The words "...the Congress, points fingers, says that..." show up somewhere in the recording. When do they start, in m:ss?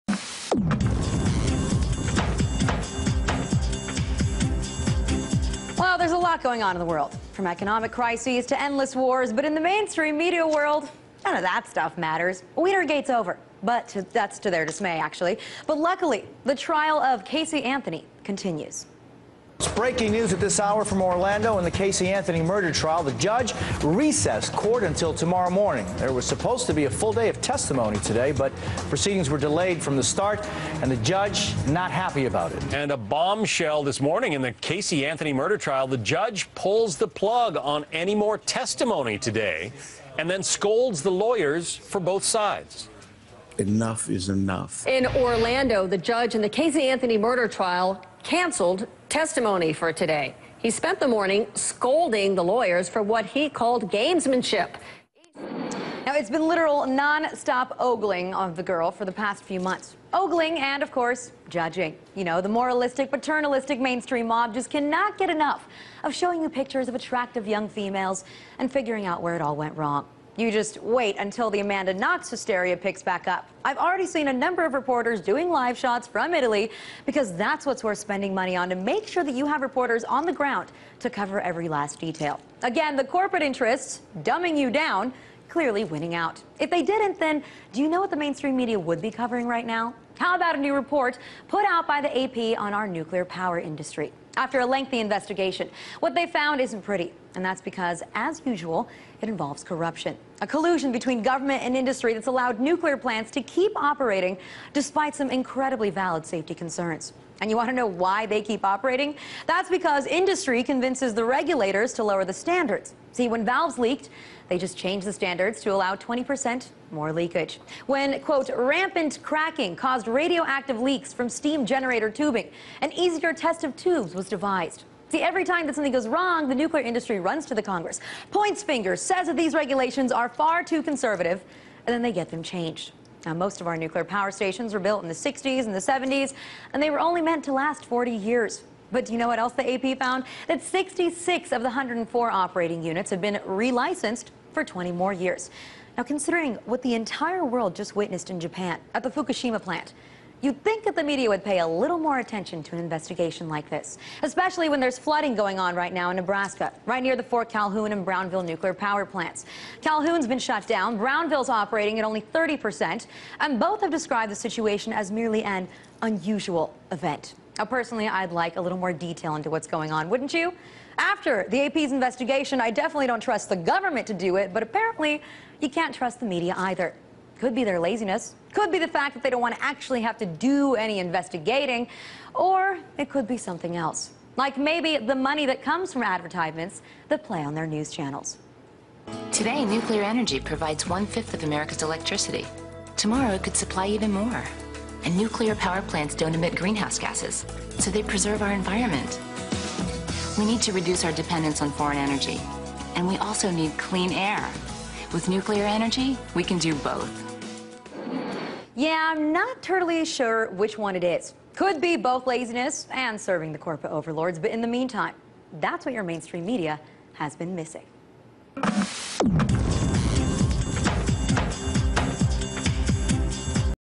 2:07.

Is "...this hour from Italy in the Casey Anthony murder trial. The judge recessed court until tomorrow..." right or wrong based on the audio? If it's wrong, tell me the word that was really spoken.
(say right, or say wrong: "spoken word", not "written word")
wrong: "Orlando", not "Italy".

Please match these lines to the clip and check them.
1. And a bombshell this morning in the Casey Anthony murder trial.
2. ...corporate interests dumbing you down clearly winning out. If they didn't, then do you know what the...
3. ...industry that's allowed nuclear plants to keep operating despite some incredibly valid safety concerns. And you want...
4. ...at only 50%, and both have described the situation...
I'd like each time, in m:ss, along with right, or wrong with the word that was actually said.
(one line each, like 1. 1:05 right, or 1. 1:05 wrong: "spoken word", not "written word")
1. 0:32 right
2. 1:23 right
3. 1:41 right
4. 2:41 wrong: "30", not "50".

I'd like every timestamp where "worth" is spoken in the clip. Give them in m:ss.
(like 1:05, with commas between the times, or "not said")
1:17.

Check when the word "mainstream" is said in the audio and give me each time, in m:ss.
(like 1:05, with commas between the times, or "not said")
0:09, 1:03, 1:28, 3:36.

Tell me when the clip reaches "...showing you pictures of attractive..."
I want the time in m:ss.
1:06.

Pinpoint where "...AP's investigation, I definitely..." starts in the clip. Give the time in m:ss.
2:51.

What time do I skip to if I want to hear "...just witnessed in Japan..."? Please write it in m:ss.
2:27.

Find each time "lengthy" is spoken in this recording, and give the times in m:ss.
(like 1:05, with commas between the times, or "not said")
1:34.